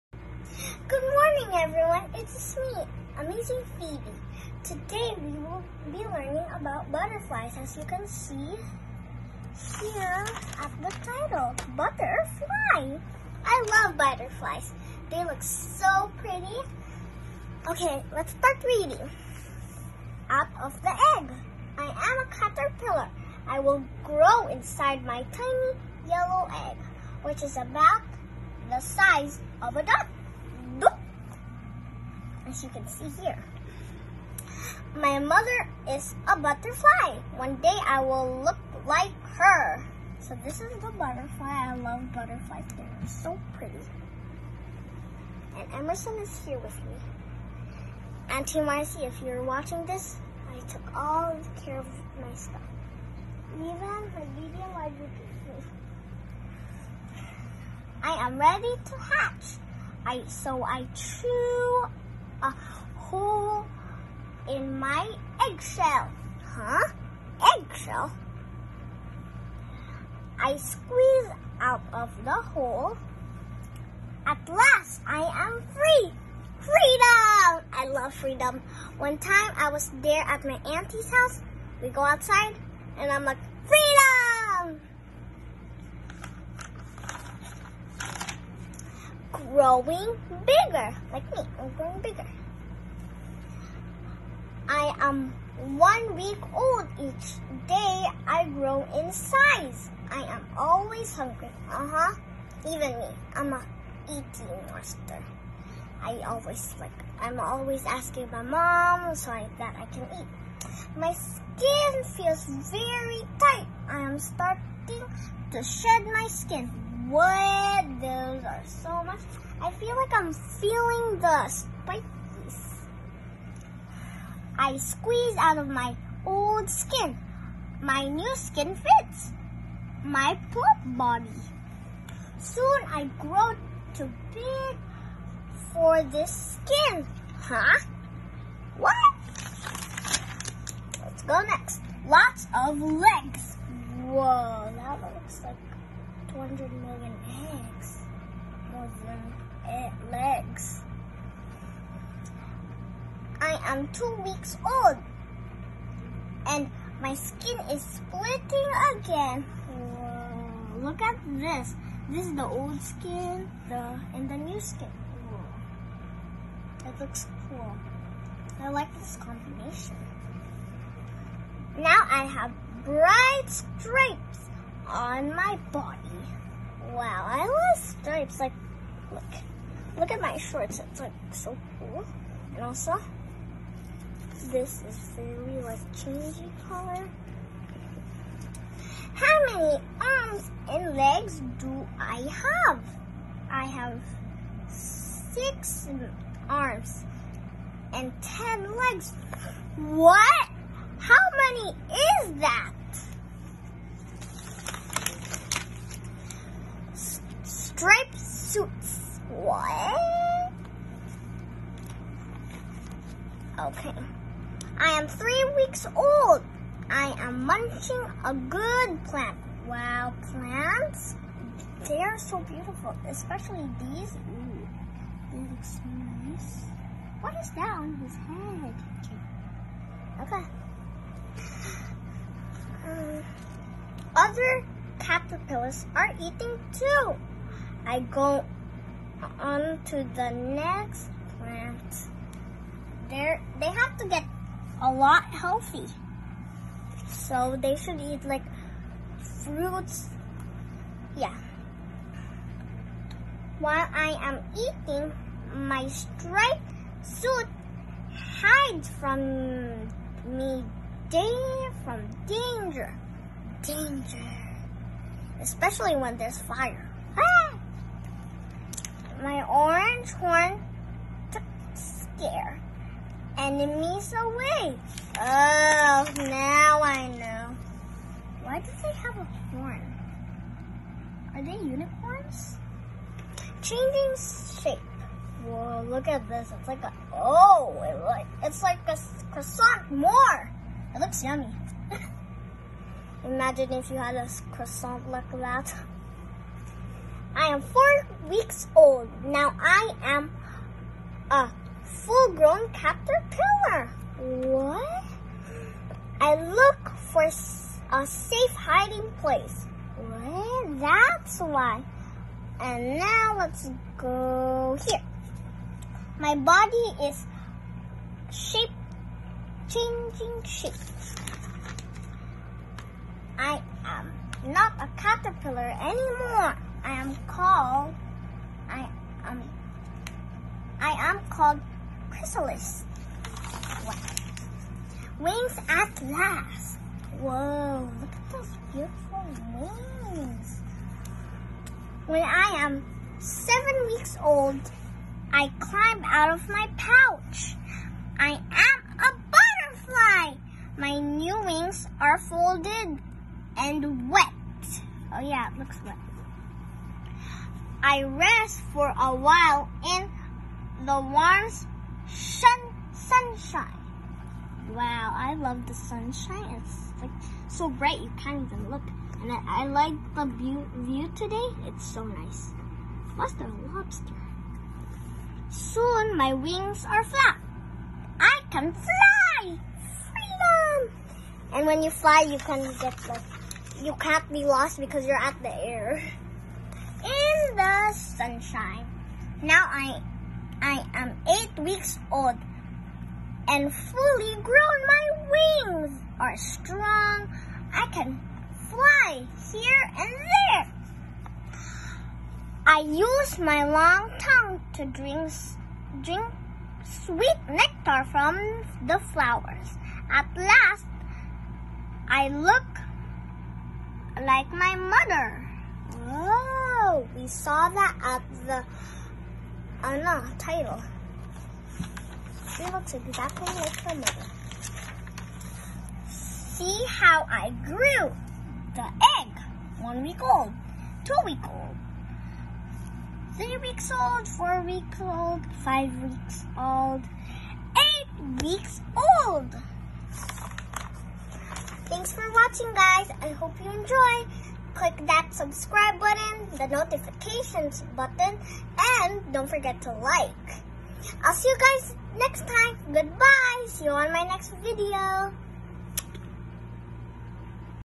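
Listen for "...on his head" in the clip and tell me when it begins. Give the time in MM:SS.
03:47.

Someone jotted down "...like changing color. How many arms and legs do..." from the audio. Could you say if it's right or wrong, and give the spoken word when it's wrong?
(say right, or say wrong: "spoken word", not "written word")
right.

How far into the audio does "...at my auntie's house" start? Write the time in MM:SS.
01:20.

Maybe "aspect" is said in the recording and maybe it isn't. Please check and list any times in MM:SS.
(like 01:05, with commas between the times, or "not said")
not said.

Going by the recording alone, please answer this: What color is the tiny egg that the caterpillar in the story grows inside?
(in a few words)
Yellow.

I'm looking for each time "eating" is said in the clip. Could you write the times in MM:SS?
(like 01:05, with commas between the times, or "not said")
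01:44, 03:56, 04:14.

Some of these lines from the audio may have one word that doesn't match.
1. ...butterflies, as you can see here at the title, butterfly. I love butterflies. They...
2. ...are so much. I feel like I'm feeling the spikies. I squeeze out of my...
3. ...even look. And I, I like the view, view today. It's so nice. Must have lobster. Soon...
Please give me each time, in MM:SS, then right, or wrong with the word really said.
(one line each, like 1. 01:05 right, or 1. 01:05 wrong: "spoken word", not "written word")
1. 00:06 right
2. 01:58 right
3. 06:08 right.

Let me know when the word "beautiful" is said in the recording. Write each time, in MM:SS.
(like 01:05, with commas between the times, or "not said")
03:42, 05:38.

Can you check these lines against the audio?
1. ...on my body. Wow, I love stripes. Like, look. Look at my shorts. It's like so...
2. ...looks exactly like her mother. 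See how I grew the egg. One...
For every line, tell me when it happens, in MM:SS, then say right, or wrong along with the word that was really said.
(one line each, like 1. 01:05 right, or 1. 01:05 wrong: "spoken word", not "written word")
1. 02:54 right
2. 07:02 right.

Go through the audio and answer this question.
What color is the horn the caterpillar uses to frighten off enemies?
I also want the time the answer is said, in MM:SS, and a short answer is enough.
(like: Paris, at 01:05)
Orange, at 04:29.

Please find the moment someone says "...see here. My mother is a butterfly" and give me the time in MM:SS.
00:32.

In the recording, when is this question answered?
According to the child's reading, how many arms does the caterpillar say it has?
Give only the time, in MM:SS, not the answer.
03:14.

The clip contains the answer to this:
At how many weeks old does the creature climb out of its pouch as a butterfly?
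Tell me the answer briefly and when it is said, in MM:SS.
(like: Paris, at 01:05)
7, at 05:43.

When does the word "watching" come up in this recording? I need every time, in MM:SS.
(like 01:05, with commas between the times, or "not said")
00:49, 07:22.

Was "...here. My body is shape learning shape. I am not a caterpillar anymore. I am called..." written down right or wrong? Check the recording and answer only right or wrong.
wrong.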